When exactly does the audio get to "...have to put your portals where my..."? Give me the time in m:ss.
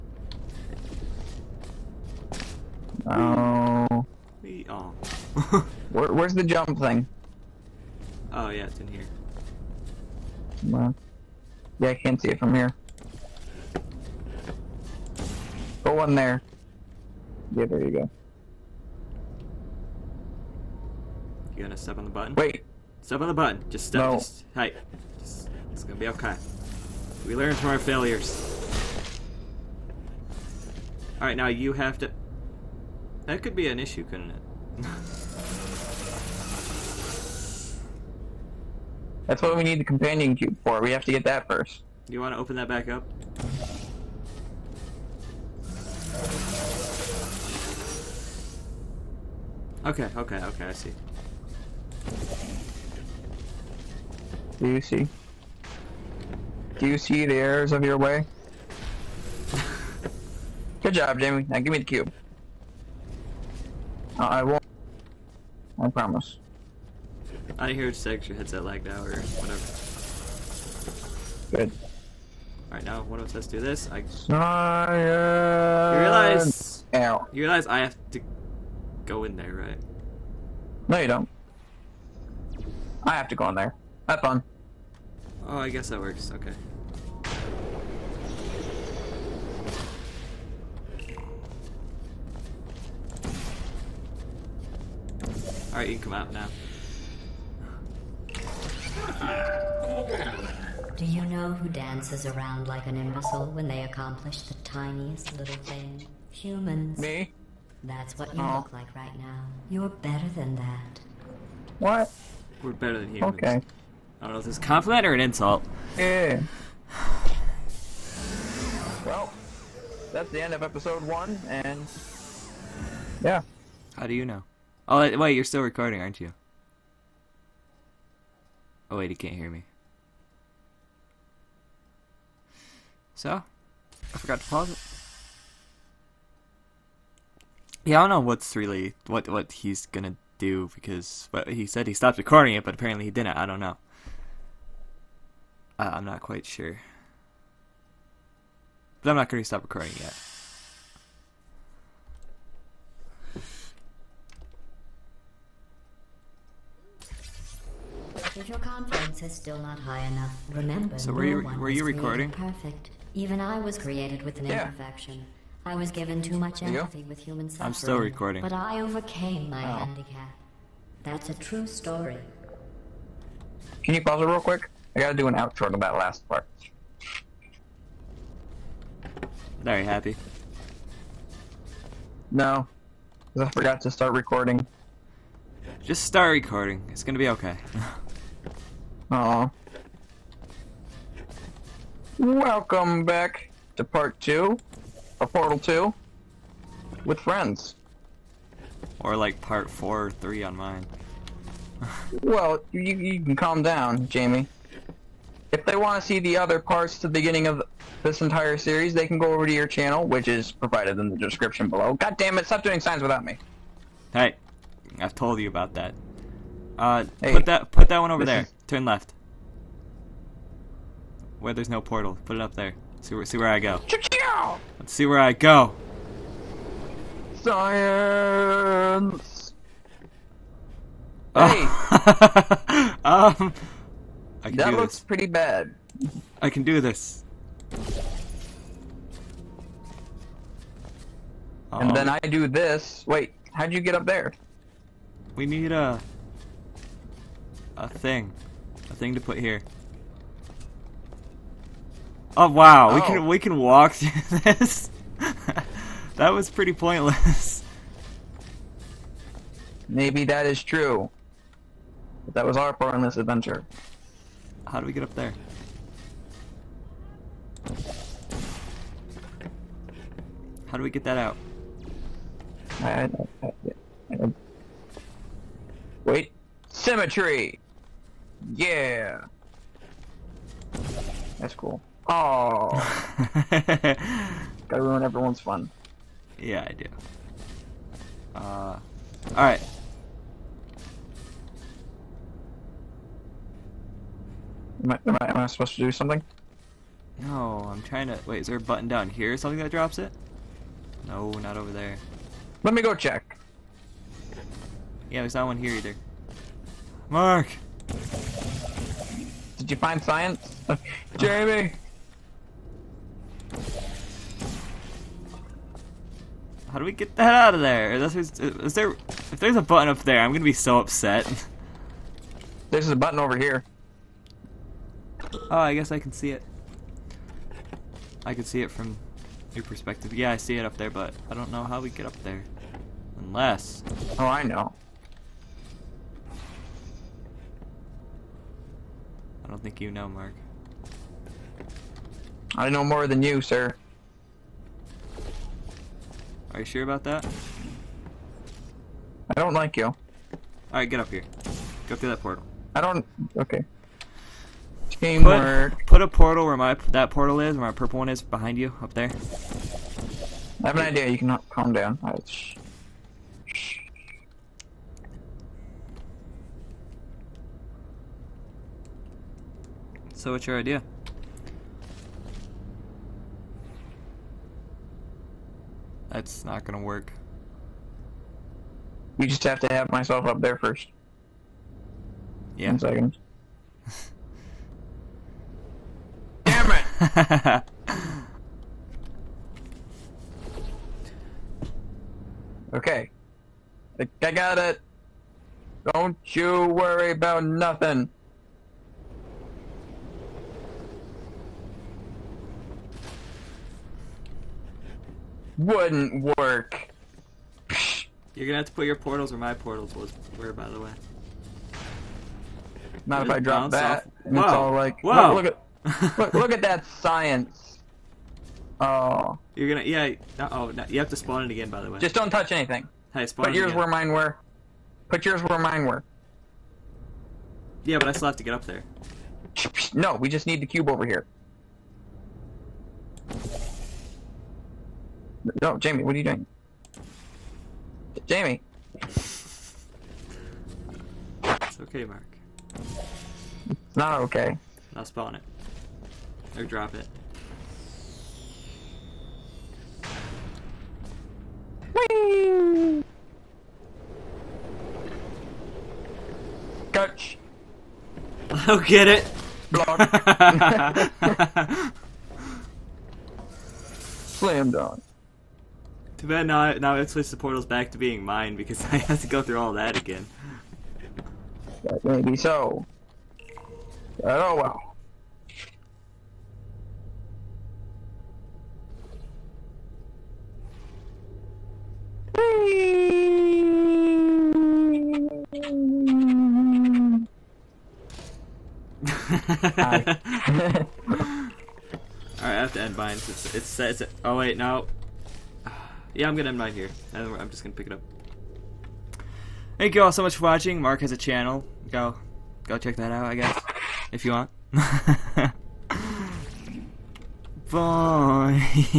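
6:48.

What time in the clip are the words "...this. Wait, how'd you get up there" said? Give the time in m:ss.
4:02.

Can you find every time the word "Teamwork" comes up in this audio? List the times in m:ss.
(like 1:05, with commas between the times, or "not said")
5:54.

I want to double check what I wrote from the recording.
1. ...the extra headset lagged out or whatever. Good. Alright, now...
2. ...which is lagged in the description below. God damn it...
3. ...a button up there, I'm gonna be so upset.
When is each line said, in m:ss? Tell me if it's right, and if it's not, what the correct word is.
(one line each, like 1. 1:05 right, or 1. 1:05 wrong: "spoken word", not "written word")
1. 1:08 right
2. 3:30 wrong: "provided", not "lagged"
3. 5:19 right.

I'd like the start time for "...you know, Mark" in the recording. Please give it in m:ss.
5:39.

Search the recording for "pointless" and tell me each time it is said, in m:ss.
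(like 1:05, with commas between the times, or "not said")
4:16.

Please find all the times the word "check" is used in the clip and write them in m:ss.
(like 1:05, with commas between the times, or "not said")
5:02, 8:22.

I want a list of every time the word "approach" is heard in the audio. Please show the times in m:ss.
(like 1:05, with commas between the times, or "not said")
not said.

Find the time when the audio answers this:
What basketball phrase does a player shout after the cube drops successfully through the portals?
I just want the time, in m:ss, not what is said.
7:44.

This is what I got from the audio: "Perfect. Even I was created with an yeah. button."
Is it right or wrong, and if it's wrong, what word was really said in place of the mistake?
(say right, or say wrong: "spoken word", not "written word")
wrong: "imperfection", not "button".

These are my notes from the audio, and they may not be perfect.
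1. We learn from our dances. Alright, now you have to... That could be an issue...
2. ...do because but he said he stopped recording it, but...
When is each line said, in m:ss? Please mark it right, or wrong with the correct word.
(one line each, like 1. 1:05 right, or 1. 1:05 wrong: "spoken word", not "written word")
1. 0:27 wrong: "failures", not "dances"
2. 2:20 right.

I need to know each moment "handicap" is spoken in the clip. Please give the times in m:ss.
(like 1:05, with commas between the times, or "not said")
2:49.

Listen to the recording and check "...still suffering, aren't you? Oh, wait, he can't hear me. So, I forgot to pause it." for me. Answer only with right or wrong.
wrong.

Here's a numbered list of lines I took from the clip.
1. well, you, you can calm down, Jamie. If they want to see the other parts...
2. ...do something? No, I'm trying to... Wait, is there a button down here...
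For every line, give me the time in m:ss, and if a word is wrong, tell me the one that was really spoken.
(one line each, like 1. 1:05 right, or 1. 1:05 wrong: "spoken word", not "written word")
1. 3:22 right
2. 4:55 right.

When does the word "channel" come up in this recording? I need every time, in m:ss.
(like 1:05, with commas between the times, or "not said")
3:29, 8:21.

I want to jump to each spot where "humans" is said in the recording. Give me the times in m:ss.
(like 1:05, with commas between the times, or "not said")
1:46, 1:53, 2:47.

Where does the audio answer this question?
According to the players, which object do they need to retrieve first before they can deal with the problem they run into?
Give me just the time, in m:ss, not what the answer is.
0:39.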